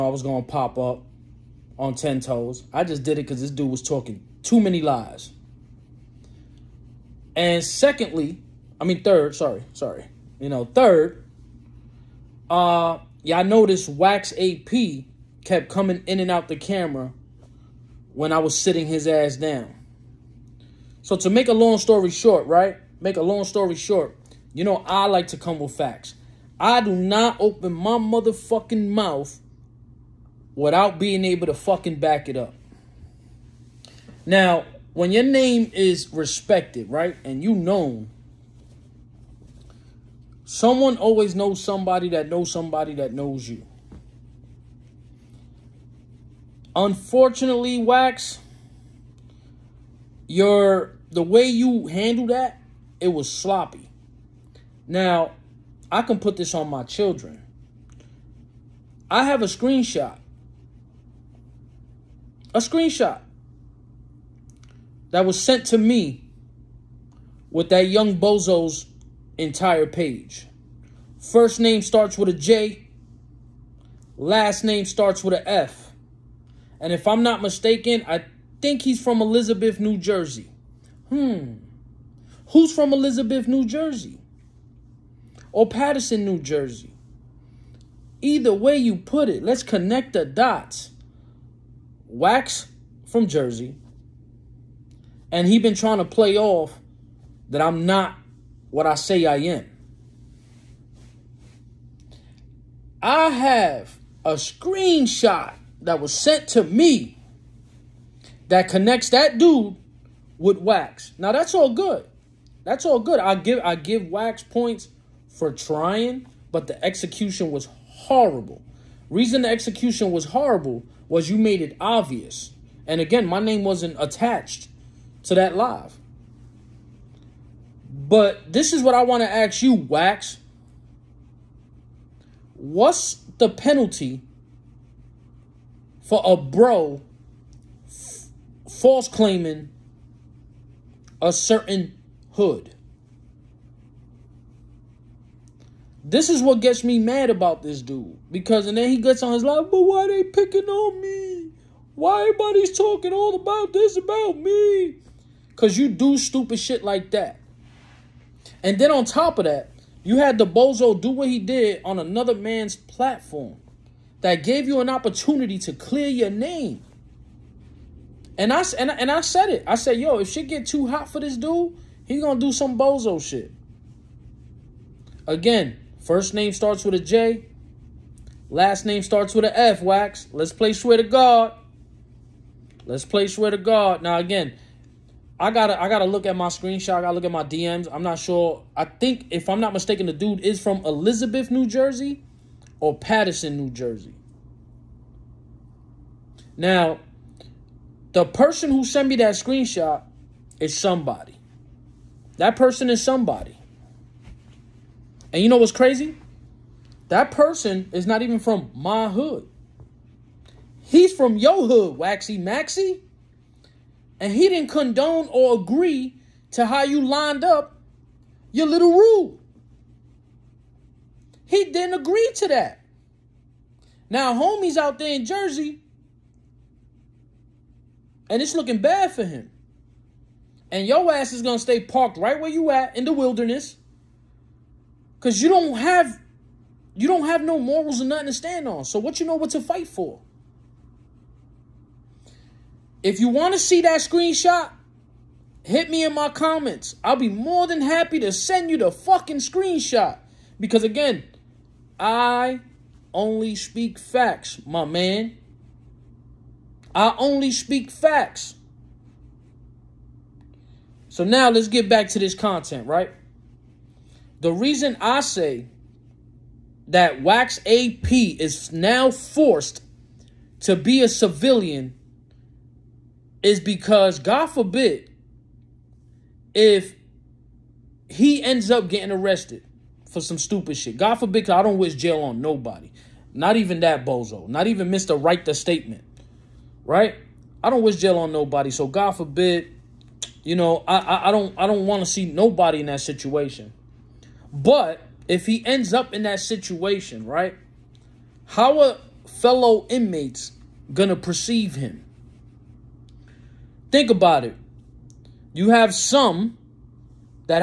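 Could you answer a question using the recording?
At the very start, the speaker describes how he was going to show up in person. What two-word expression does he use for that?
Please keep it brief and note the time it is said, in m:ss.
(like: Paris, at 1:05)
ten toes, at 0:01.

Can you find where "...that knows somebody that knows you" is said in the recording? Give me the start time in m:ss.
0:42.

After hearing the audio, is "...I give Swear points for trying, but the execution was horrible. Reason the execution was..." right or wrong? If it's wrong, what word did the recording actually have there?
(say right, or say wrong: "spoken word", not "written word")
wrong: "Wax", not "Swear".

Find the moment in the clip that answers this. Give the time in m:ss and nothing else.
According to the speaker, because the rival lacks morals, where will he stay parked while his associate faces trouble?
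3:53.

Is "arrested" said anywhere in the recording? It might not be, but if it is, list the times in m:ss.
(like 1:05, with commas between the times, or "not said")
4:39.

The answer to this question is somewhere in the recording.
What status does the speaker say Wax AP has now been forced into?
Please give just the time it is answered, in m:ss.
4:31.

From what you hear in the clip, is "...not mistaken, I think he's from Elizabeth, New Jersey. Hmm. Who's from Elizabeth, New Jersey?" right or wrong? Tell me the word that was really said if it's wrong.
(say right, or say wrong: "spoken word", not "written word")
right.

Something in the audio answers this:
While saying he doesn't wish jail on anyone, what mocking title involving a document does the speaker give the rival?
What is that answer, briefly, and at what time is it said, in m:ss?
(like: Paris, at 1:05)
Mr. Write the Statement, at 4:44.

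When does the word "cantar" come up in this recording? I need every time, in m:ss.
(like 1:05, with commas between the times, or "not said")
not said.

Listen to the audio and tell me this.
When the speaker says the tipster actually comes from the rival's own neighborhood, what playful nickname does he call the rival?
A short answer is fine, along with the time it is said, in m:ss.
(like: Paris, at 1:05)
Waxy Maxy, at 3:31.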